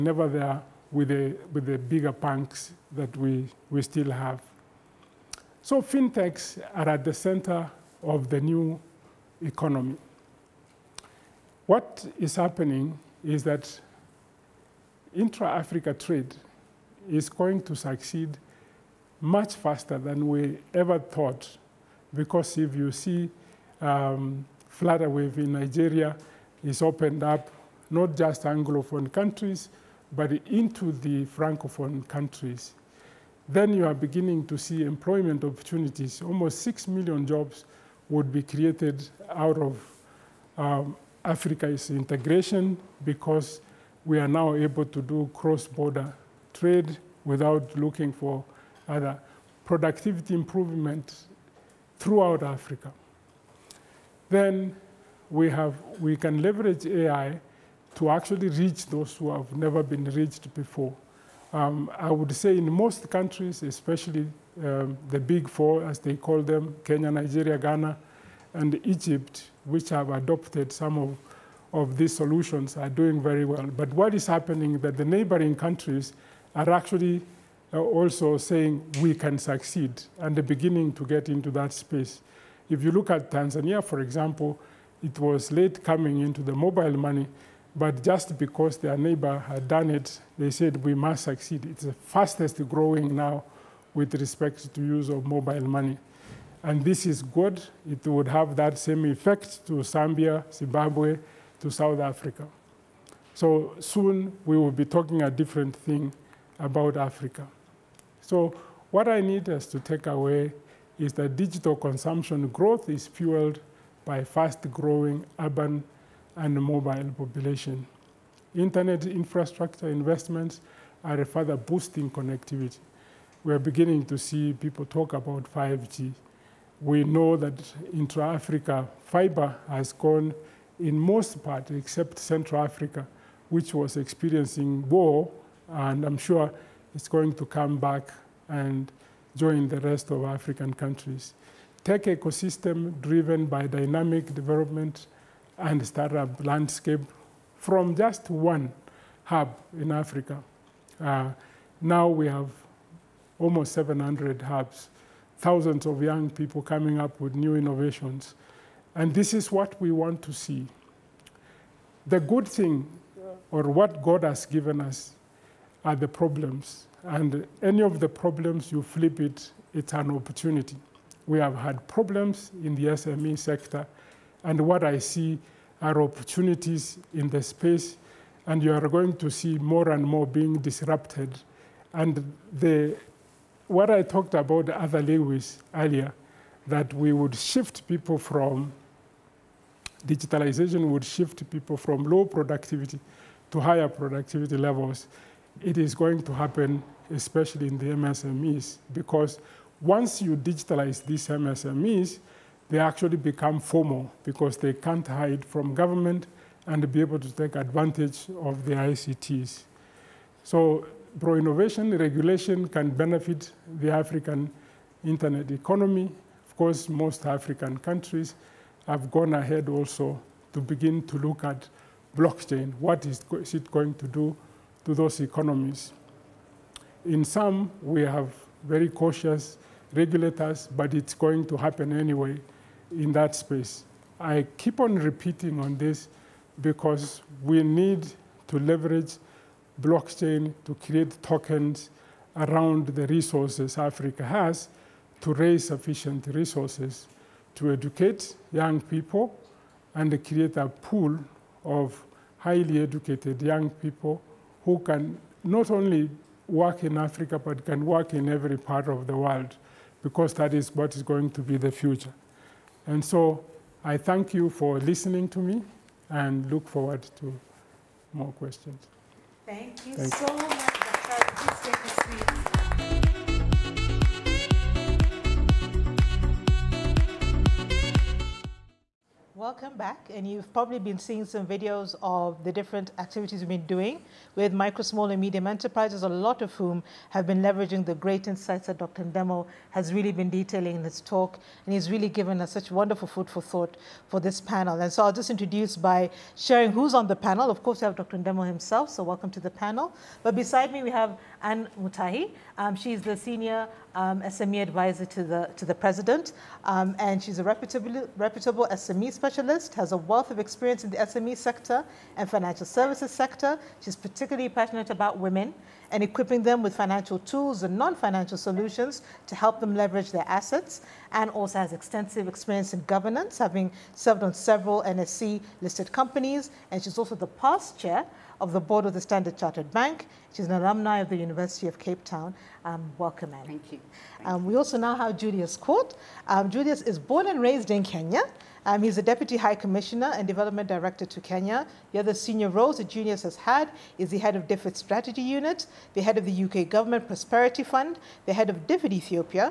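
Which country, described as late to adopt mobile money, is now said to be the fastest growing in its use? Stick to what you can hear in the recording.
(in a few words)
Tanzania.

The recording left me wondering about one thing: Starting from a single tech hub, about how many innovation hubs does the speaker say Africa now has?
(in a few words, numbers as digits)
700.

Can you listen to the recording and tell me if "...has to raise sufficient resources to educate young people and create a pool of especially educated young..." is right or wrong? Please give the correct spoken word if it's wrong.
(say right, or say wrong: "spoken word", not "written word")
wrong: "highly", not "especially".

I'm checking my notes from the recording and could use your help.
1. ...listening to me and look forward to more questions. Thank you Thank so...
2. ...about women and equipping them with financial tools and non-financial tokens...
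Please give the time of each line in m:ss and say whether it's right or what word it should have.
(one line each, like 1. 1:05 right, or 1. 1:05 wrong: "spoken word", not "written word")
1. 4:24 right
2. 5:14 wrong: "solutions", not "tokens".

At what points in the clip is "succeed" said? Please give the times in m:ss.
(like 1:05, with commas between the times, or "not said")
0:17, 1:19, 1:31.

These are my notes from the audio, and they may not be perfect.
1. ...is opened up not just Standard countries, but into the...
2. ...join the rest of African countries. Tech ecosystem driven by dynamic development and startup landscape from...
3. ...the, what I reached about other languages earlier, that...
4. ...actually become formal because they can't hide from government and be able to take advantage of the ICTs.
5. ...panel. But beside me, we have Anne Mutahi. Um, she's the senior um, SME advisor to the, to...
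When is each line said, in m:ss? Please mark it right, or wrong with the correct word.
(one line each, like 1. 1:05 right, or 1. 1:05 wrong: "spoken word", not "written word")
1. 0:26 wrong: "Anglophone", not "Standard"
2. 2:19 right
3. 3:02 wrong: "talked", not "reached"
4. 3:22 right
5. 4:59 right.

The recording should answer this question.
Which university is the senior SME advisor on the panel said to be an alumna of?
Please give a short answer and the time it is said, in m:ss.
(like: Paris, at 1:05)
University of Cape Town, at 5:31.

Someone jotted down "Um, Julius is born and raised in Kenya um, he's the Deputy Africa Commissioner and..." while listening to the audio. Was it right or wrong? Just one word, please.
wrong.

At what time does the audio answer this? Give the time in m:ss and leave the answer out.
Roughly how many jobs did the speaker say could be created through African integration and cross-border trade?
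0:36.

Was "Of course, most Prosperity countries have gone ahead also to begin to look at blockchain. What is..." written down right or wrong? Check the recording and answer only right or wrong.
wrong.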